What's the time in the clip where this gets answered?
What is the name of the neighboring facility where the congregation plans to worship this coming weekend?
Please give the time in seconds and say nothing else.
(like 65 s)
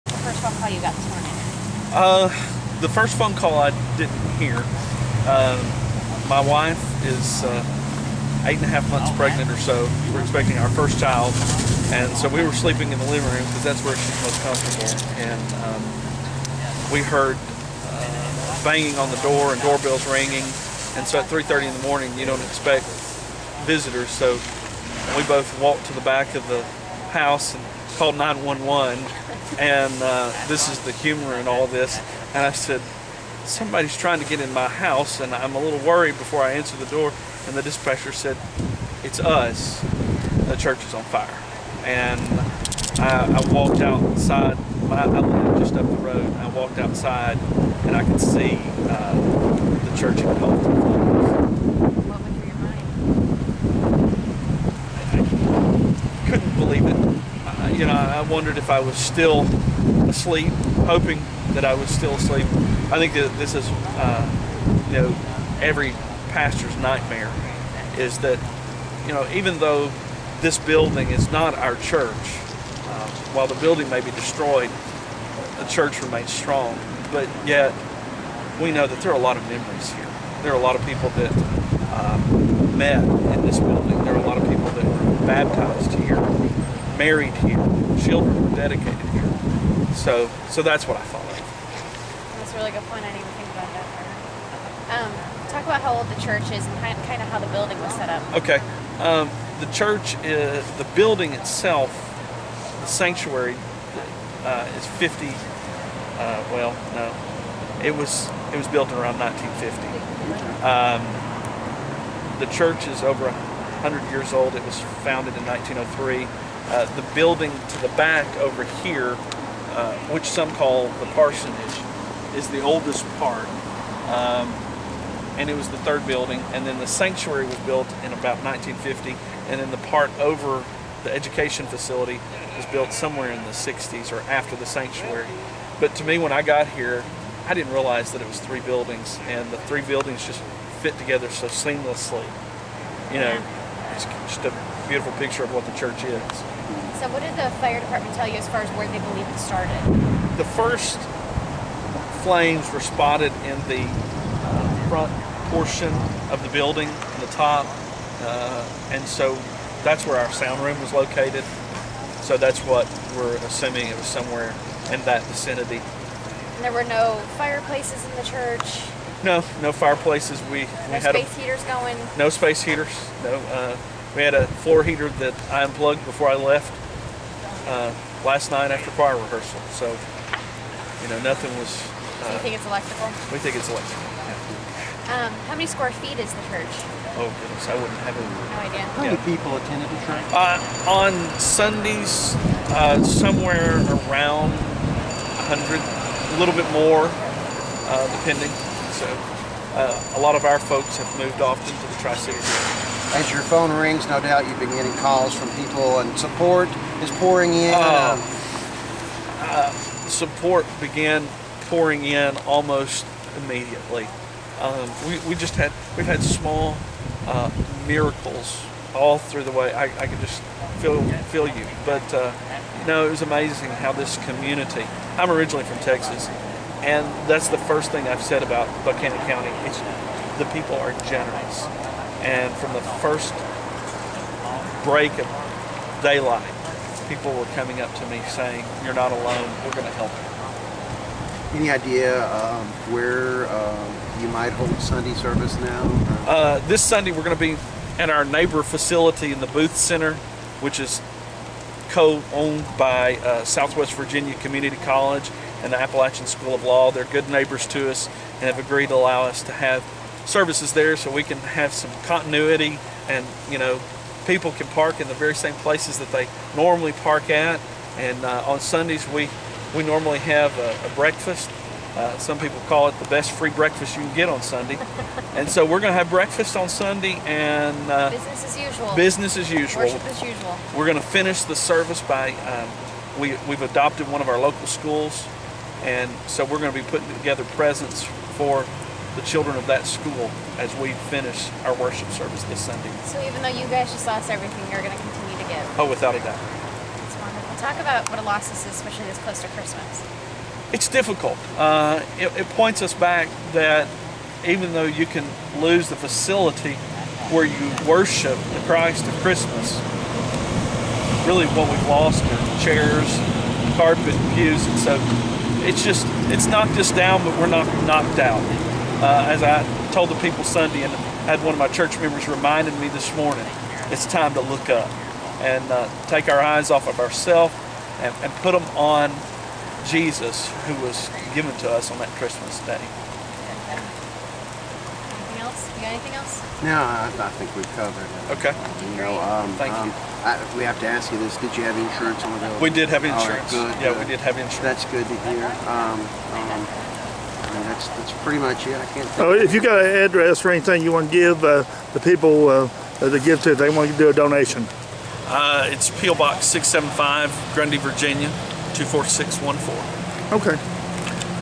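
249 s.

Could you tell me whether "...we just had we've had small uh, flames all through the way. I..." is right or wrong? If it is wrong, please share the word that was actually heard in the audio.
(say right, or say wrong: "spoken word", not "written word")
wrong: "miracles", not "flames".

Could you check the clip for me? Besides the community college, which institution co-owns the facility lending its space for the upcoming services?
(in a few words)
Appalachian School of Law.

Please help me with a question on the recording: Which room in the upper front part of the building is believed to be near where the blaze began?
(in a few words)
sound room.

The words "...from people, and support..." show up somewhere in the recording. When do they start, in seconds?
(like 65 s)
205 s.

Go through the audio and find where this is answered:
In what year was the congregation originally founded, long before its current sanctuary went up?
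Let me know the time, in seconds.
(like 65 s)
115 s.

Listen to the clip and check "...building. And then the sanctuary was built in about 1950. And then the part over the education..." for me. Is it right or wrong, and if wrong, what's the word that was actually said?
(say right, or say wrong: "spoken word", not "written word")
right.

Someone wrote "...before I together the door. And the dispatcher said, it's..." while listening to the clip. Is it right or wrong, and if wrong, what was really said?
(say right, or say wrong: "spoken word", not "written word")
wrong: "answer", not "together".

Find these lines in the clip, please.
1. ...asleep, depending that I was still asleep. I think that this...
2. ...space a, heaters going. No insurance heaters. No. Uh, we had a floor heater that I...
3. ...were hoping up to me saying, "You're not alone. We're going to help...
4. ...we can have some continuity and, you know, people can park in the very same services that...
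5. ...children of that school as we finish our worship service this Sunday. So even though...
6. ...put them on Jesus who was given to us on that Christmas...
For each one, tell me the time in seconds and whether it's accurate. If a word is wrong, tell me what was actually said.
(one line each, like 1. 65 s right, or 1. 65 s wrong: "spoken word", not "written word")
1. 60 s wrong: "hoping", not "depending"
2. 171 s wrong: "space", not "insurance"
3. 237 s wrong: "coming", not "hoping"
4. 261 s wrong: "places", not "services"
5. 289 s right
6. 328 s right.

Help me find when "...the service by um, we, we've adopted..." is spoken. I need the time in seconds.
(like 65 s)
281 s.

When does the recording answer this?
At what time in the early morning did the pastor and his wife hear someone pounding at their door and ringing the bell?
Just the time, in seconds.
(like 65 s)
21 s.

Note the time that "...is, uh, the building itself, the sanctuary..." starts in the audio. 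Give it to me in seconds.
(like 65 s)
100 s.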